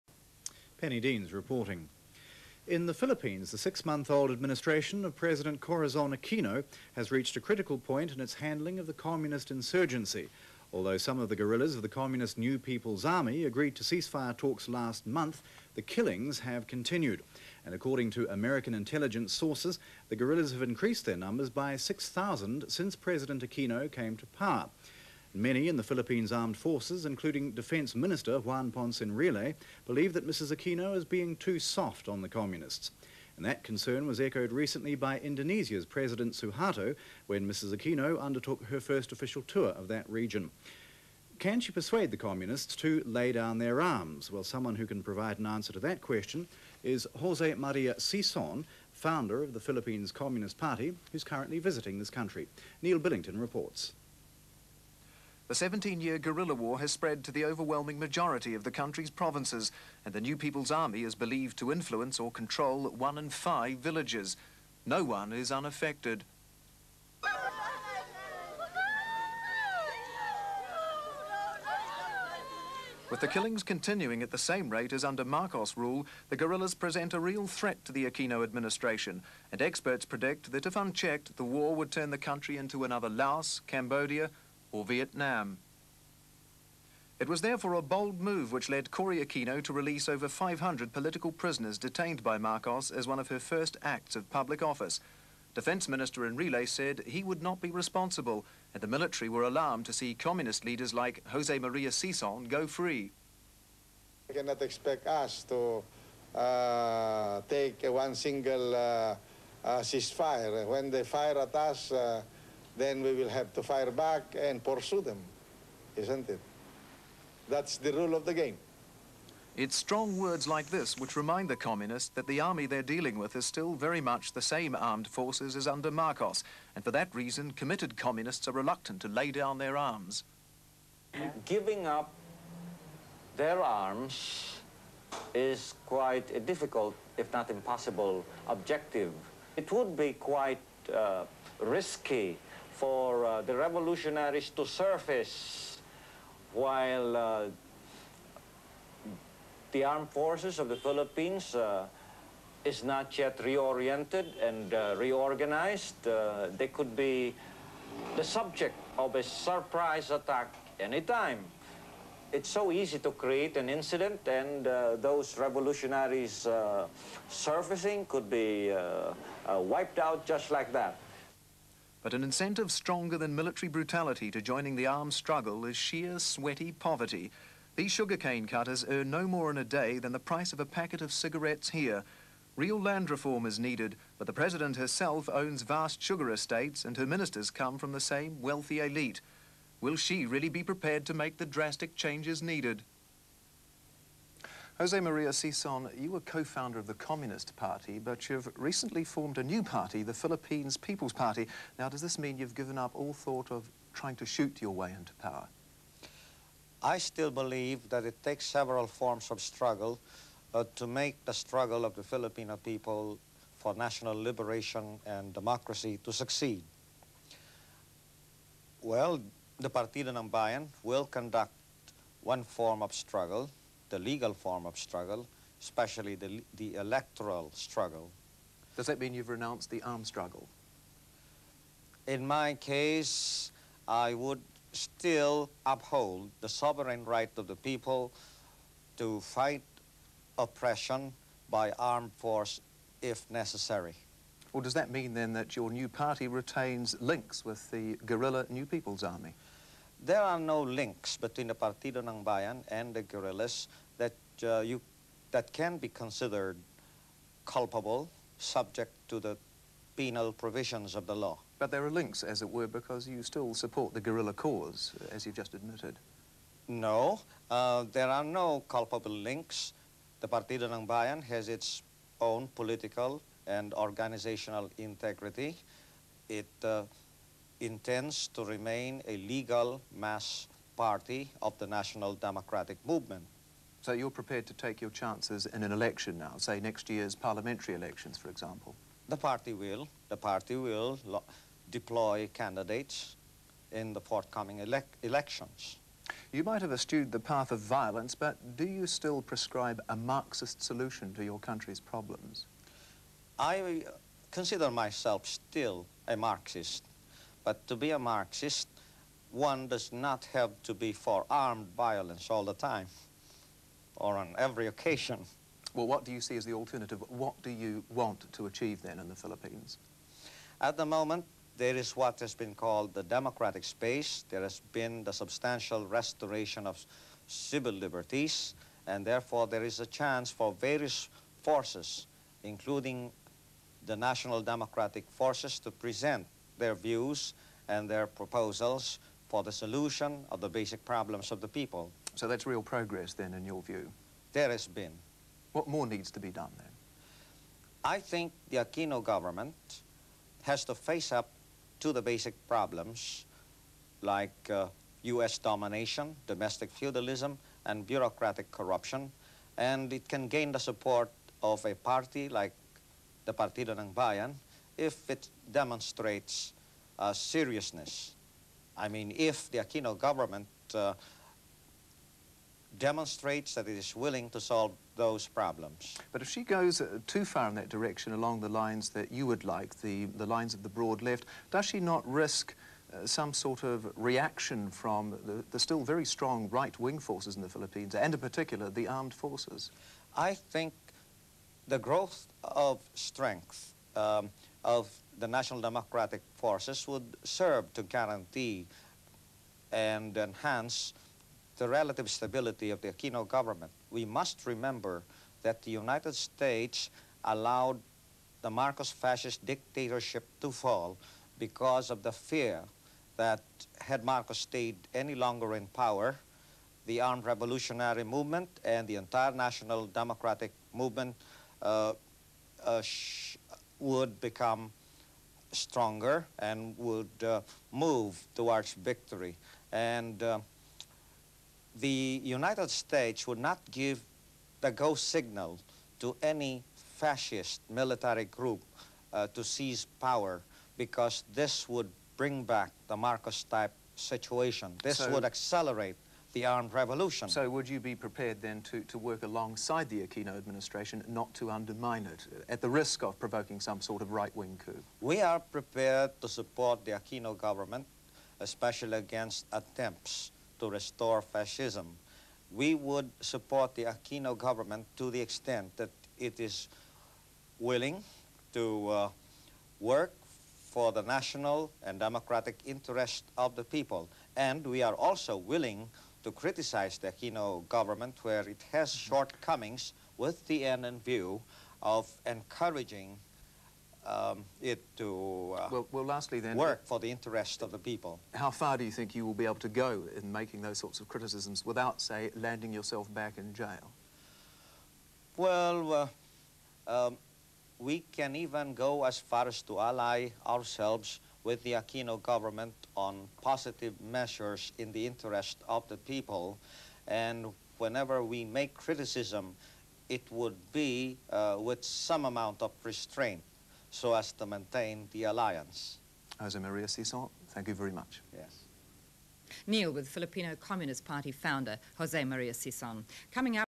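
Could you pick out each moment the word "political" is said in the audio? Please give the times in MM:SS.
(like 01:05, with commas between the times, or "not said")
01:30, 04:32.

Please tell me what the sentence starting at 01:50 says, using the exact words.
When they fire at us, uh, then we will have to fire back and pursue them, isn't it?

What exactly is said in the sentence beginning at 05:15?
Well, what do you see as the alternative?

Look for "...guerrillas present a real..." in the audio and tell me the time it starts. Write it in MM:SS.
01:16.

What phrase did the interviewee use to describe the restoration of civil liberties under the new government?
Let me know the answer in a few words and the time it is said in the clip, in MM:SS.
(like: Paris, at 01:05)
Democratic space, at 05:23.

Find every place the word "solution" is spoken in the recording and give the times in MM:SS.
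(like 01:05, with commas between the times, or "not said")
05:00, 05:39.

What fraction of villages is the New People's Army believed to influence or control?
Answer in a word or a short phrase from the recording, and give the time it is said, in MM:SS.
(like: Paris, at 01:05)
One in five, at 01:02.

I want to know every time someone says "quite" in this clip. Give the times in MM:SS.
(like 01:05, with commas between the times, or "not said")
02:15, 02:20.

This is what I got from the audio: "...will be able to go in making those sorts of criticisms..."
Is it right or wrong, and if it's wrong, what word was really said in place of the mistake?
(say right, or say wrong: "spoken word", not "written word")
right.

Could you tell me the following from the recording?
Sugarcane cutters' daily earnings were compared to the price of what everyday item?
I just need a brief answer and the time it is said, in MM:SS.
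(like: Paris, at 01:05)
A packet of cigarettes, at 03:00.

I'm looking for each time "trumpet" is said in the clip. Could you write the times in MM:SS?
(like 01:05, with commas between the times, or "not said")
not said.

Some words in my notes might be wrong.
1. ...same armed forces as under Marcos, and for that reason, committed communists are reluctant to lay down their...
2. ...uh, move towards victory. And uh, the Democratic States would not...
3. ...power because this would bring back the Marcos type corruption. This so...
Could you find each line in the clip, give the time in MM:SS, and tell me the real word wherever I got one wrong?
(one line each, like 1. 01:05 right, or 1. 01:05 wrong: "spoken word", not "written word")
1. 02:04 right
2. 07:07 wrong: "United", not "Democratic"
3. 07:19 wrong: "situation", not "corruption".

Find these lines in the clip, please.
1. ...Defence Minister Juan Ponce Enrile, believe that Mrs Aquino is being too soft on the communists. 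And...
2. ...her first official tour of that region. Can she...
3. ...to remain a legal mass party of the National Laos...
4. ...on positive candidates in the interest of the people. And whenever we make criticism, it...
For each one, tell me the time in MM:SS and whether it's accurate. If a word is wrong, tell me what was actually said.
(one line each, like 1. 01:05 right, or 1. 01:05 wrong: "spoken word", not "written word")
1. 00:27 right
2. 00:38 right
3. 04:38 wrong: "Democratic", not "Laos"
4. 08:22 wrong: "measures", not "candidates".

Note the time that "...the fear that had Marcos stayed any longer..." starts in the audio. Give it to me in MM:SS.
06:52.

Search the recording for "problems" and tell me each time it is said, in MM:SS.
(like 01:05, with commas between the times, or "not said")
05:01, 05:40, 05:52, 06:15.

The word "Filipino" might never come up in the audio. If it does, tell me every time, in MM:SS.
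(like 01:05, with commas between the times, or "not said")
03:32, 08:40.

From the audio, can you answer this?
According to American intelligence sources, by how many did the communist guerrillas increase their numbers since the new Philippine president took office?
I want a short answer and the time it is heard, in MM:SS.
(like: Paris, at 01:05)
6,000, at 00:21.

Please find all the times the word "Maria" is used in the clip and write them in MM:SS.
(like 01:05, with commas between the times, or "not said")
00:47, 01:41, 03:14, 08:36, 08:42.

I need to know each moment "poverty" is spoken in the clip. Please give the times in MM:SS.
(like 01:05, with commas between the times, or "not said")
02:56.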